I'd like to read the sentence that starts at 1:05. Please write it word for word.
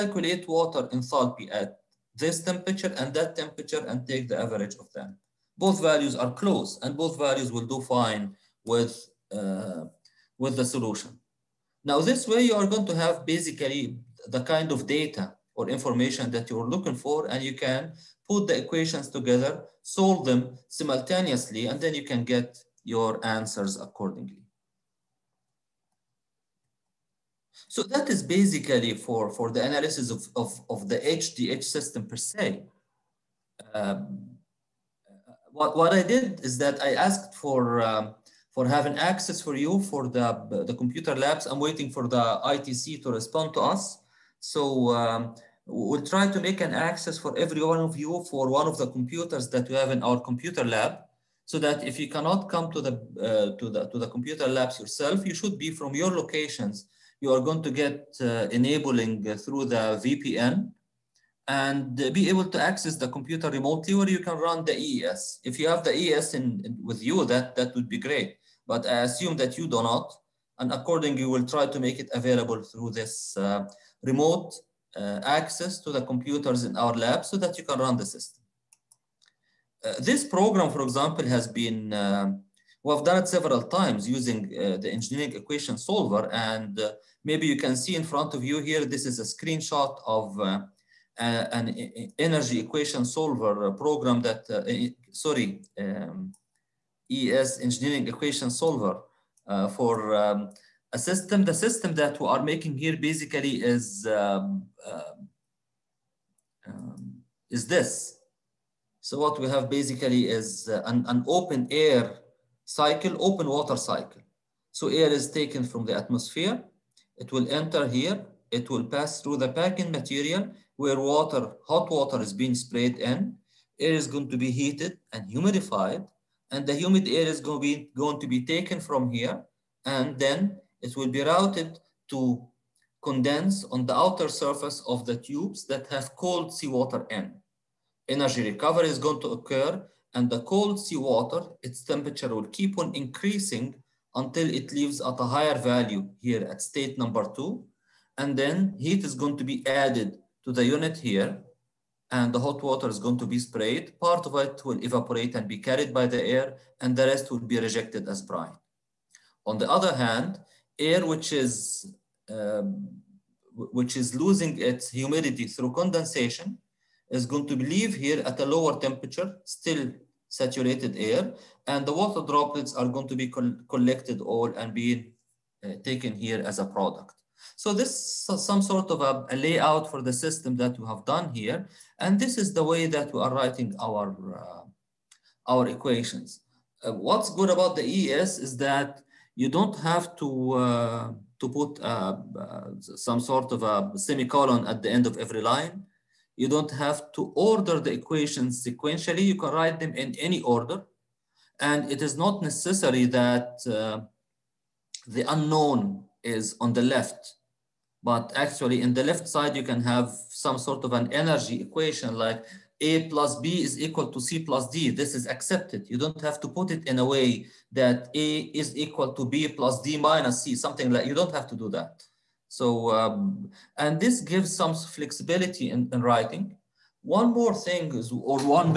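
If you have the EES in, in, with you, that, that would be great.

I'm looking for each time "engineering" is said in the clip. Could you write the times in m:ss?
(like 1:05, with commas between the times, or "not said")
1:24, 1:37.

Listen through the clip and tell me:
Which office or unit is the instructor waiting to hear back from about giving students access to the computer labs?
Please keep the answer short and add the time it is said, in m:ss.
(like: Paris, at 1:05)
ITC, at 0:42.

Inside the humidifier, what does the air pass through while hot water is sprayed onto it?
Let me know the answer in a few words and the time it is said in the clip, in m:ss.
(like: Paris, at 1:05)
packing material, at 1:59.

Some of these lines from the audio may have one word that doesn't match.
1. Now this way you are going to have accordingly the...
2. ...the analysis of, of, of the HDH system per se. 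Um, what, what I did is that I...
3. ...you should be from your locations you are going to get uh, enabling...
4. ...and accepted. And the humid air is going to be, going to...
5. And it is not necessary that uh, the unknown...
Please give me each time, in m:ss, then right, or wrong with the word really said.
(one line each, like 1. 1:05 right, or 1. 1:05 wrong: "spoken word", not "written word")
1. 0:11 wrong: "basically", not "accordingly"
2. 0:29 right
3. 0:55 right
4. 2:05 wrong: "humidified", not "accepted"
5. 3:21 right.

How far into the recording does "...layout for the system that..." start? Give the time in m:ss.
2:59.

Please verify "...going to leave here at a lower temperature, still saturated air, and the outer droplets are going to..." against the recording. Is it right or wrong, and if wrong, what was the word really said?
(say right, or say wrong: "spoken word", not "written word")
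wrong: "water", not "outer".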